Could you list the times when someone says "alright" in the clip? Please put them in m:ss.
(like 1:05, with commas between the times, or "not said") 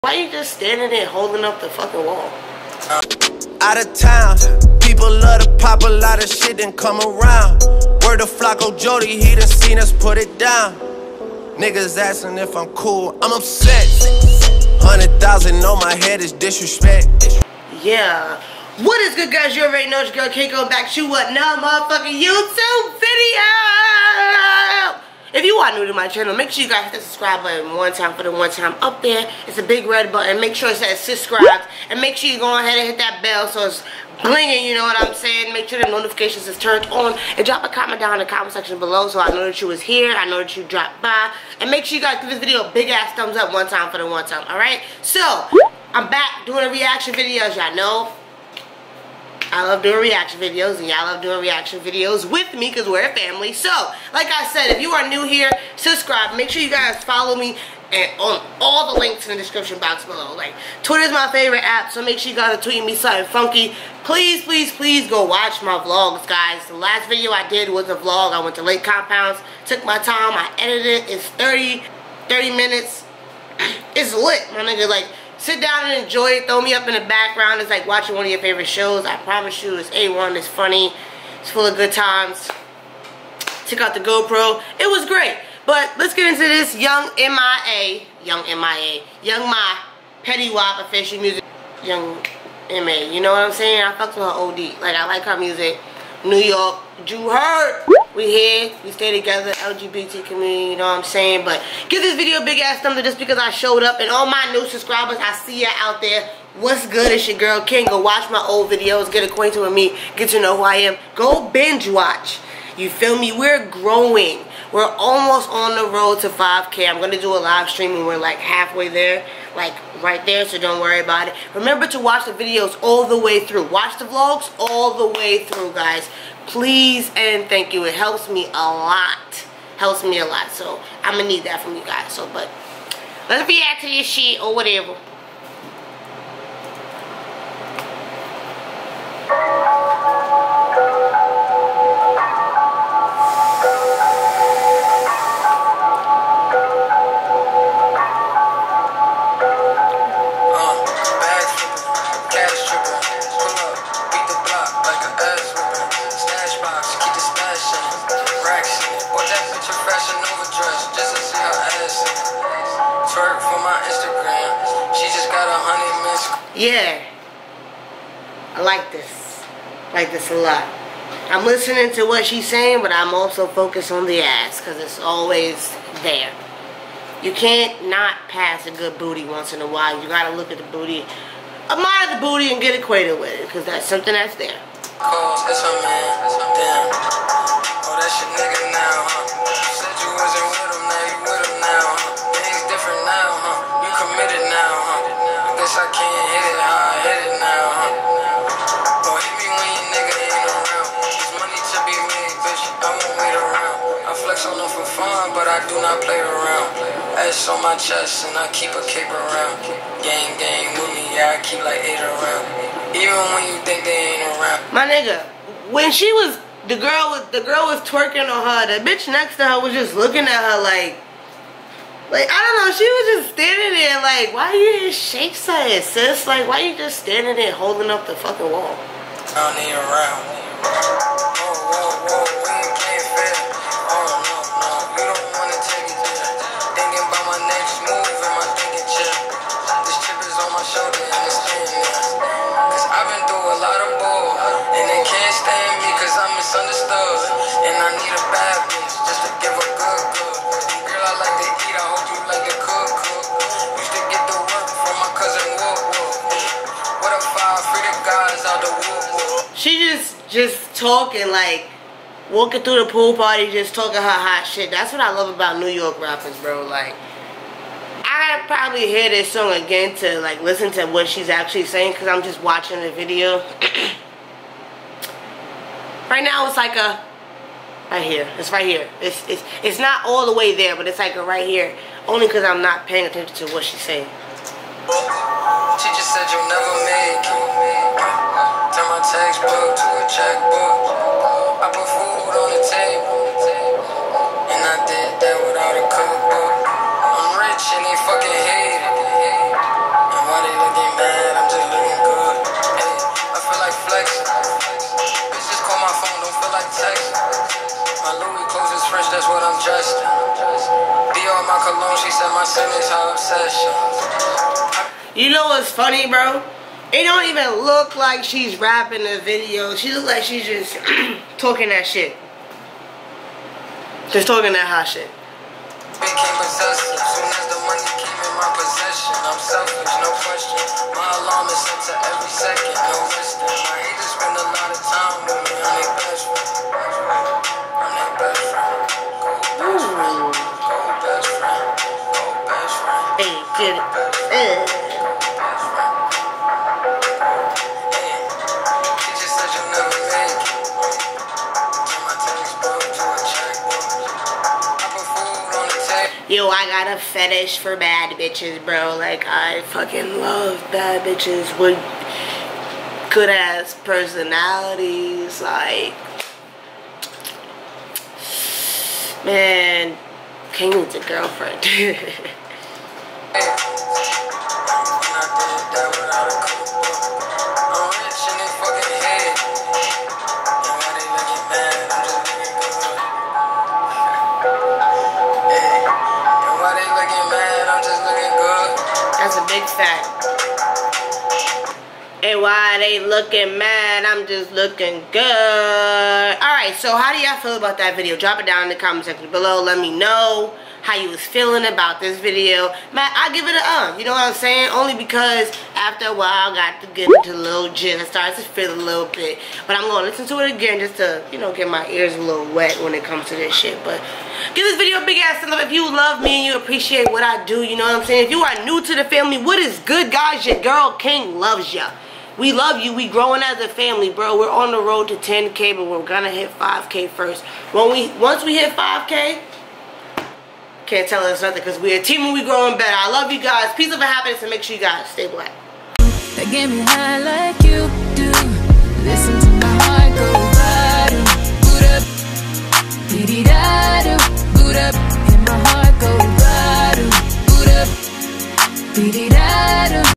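0:44, 6:36.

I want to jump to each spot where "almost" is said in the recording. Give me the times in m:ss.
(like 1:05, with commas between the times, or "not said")
1:54.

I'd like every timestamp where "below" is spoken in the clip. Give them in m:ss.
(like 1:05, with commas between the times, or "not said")
0:38, 1:00, 6:39.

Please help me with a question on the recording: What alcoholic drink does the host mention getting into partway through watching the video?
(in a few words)
gin.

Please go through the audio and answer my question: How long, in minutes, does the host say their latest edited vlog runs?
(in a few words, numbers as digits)
30 minutes.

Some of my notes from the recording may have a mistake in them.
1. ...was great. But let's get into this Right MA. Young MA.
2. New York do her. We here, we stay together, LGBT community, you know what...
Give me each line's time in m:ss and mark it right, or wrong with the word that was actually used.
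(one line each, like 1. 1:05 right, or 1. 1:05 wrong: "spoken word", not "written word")
1. 1:24 wrong: "Young", not "Right"
2. 1:36 right.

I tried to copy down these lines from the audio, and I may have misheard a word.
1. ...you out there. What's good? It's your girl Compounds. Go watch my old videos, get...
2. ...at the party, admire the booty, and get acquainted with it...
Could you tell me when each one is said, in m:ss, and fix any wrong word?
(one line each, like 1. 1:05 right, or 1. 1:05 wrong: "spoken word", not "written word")
1. 1:45 wrong: "King", not "Compounds"
2. 3:00 wrong: "booty", not "party".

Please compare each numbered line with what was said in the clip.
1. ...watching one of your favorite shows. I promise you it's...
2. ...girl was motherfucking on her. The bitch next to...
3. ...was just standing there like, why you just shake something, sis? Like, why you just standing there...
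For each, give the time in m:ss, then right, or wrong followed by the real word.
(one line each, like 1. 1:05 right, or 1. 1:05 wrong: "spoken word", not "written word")
1. 1:17 right
2. 3:37 wrong: "twerking", not "motherfucking"
3. 3:42 right.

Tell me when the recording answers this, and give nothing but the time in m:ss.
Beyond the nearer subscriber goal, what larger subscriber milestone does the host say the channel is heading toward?
7:05.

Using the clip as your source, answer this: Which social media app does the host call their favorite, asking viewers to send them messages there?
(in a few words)
Twitter.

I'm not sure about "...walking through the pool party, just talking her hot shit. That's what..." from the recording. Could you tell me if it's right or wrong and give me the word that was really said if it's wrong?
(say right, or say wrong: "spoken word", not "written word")
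right.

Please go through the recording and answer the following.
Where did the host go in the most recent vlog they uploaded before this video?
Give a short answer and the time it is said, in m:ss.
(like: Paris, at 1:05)
Lake Compounds, at 1:08.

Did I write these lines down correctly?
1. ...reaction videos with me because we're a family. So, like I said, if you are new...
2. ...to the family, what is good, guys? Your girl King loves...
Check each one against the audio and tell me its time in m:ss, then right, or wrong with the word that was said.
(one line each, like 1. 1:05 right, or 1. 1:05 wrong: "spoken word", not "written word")
1. 0:51 right
2. 6:58 right.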